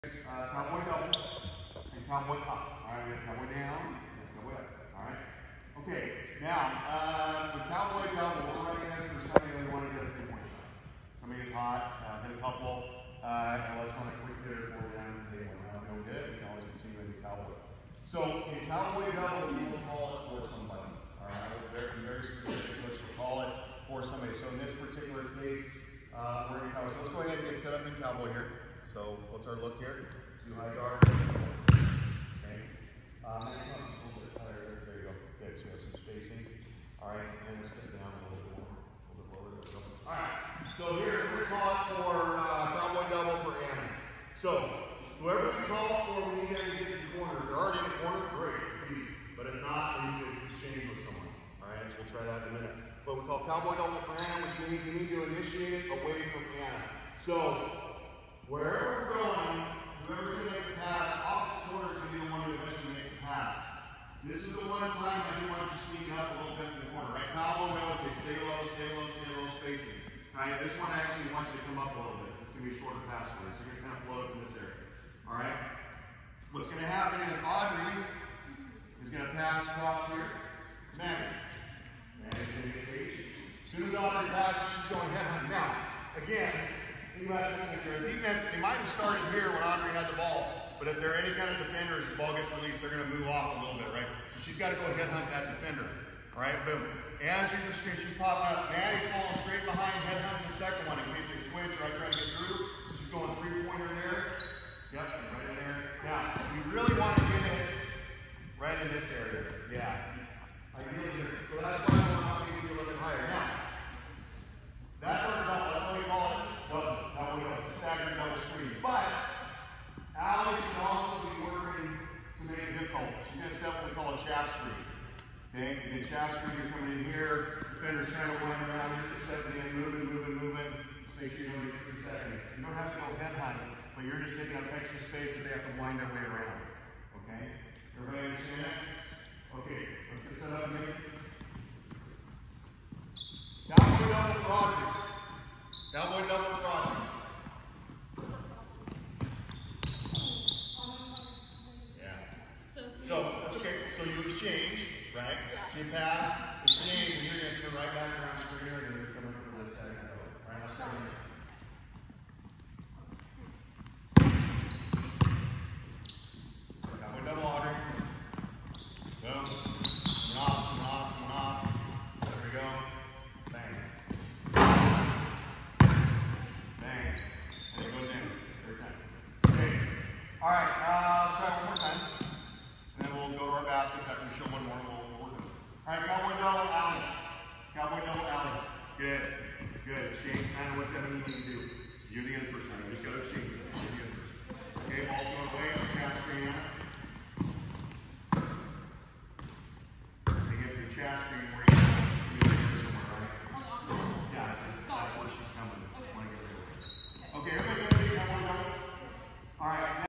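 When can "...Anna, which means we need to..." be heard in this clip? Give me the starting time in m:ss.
0:54.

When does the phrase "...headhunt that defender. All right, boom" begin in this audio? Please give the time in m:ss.
1:34.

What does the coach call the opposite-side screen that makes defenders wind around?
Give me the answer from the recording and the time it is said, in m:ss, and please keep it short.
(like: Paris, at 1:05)
chastity, at 2:04.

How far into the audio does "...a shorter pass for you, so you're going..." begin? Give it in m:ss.
1:12.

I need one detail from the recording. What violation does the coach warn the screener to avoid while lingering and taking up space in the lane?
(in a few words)
Three seconds.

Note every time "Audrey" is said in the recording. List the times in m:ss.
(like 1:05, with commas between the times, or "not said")
1:17, 1:23.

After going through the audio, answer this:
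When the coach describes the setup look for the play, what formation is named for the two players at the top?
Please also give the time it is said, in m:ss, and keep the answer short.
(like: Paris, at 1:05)
Two high guard, at 0:30.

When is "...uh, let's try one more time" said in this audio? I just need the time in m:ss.
3:00.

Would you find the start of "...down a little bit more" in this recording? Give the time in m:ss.
0:37.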